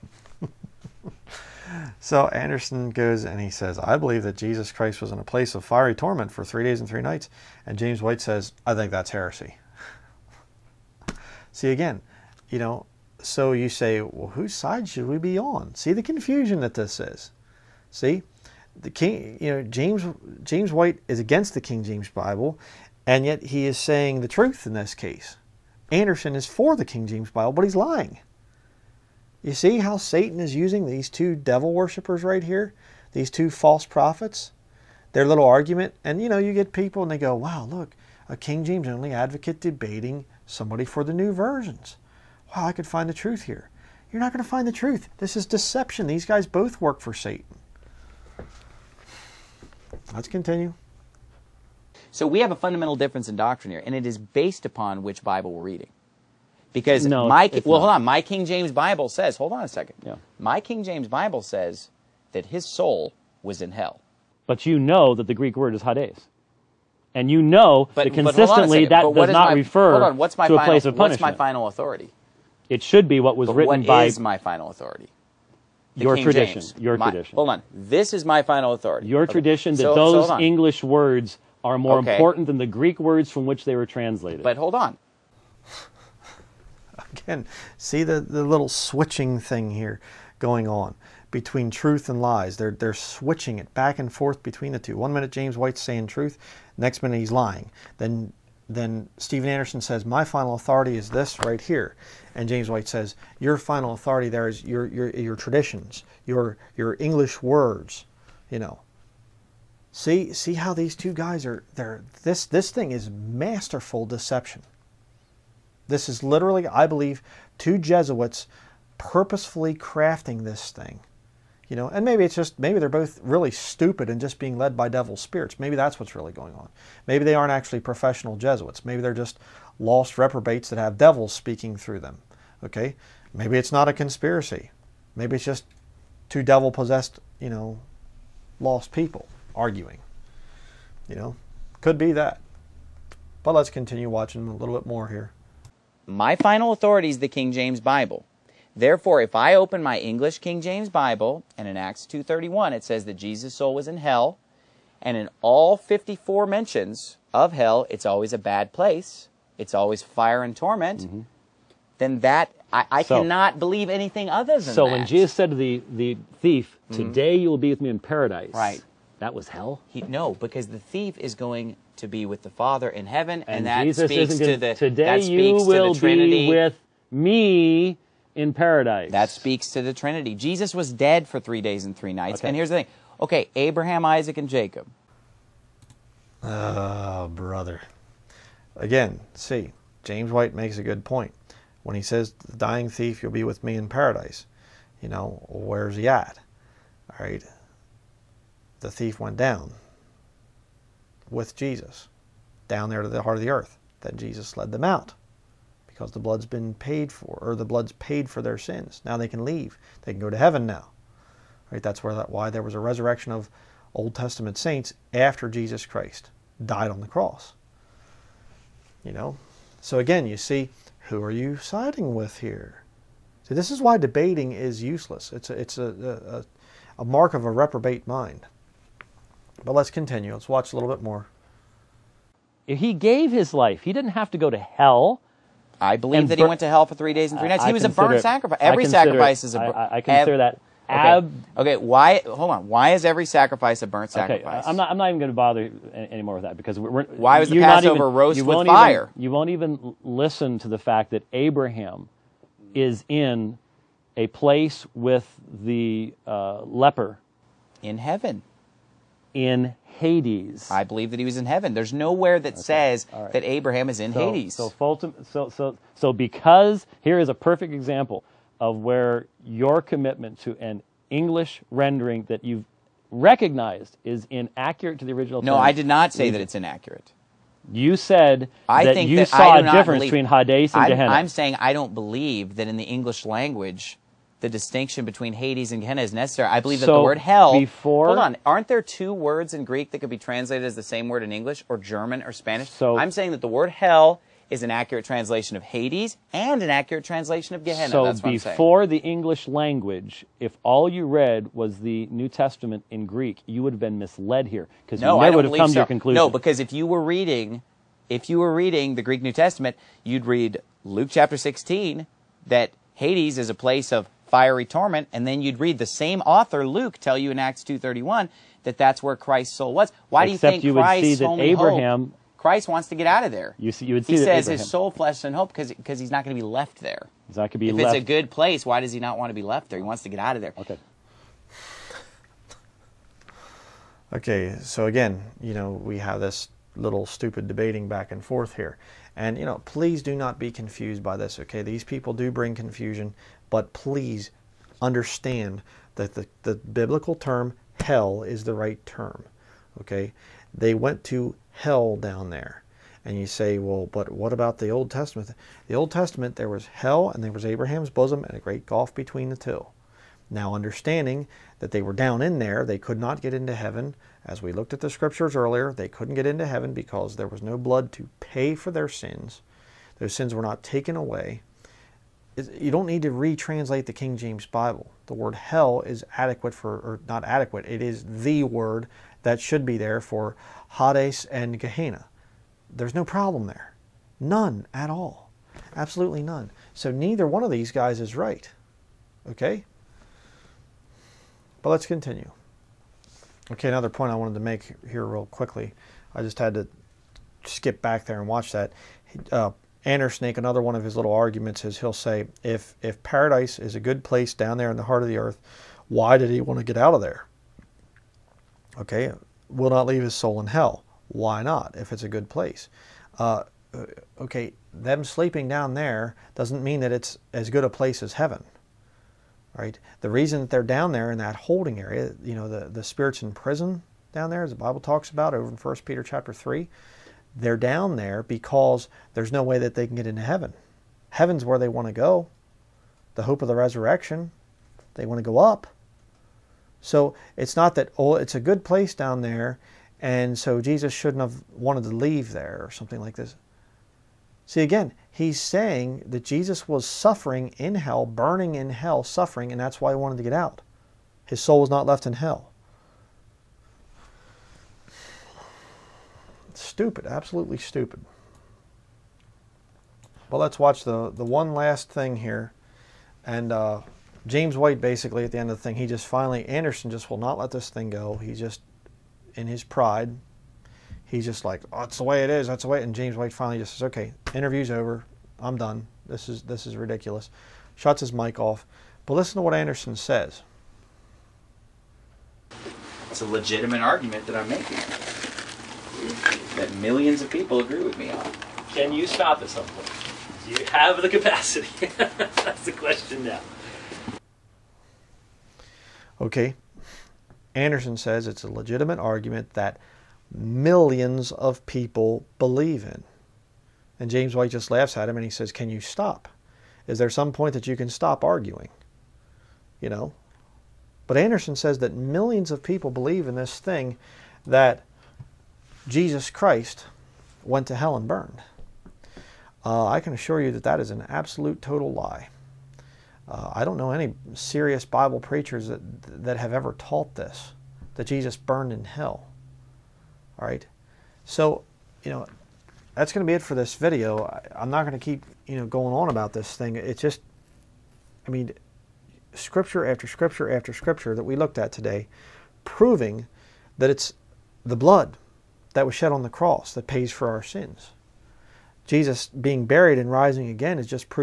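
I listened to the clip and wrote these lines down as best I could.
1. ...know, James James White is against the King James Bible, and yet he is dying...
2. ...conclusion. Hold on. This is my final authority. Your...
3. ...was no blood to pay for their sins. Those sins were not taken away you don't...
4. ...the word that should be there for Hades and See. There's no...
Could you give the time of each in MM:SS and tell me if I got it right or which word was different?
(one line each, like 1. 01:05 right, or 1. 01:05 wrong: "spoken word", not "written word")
1. 00:19 wrong: "saying", not "dying"
2. 01:17 wrong: "tradition", not "conclusion"
3. 06:07 right
4. 06:18 wrong: "Gehenna", not "See".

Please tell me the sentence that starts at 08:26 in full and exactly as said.
Is there some point that you can stop arguing?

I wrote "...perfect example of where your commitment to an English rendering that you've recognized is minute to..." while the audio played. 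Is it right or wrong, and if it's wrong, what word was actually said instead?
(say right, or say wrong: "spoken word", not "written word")
wrong: "inaccurate", not "minute".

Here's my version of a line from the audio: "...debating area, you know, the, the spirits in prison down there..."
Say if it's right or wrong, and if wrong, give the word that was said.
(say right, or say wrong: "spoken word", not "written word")
wrong: "holding", not "debating".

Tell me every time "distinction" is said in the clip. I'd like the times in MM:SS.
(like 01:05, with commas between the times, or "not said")
04:44.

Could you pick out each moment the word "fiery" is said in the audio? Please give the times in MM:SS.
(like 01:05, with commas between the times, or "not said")
00:05, 05:14.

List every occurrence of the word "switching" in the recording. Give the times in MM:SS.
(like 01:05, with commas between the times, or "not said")
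01:28, 01:32.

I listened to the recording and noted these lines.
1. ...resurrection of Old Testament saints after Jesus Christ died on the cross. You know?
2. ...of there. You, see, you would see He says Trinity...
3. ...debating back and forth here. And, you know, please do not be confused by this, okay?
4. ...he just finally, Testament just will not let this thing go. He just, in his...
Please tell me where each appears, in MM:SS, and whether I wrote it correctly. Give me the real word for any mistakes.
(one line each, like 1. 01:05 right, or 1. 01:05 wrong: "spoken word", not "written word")
1. 03:32 right
2. 05:23 wrong: "Abraham", not "Trinity"
3. 05:37 right
4. 07:45 wrong: "Anderson", not "Testament".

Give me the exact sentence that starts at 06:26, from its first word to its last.
So neither one of these guys is right.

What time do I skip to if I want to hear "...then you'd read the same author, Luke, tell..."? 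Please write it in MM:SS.
05:15.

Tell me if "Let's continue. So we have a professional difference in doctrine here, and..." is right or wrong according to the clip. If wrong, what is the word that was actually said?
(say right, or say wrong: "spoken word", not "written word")
wrong: "fundamental", not "professional".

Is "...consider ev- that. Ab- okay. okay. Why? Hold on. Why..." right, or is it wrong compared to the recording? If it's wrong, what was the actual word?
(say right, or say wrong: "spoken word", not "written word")
right.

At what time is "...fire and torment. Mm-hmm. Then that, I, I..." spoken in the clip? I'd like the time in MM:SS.
02:40.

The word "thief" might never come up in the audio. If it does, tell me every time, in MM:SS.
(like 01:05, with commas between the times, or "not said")
02:46, 02:50, 03:12, 03:18.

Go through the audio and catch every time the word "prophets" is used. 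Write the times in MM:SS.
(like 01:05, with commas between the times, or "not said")
00:33.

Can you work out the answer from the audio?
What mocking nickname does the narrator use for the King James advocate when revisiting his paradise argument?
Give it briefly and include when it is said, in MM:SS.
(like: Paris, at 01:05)
Andersnake, at 06:39.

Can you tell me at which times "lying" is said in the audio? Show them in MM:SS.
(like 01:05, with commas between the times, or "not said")
00:27, 01:37.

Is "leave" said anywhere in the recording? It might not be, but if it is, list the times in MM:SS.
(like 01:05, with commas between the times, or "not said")
03:29, 06:49, 07:21.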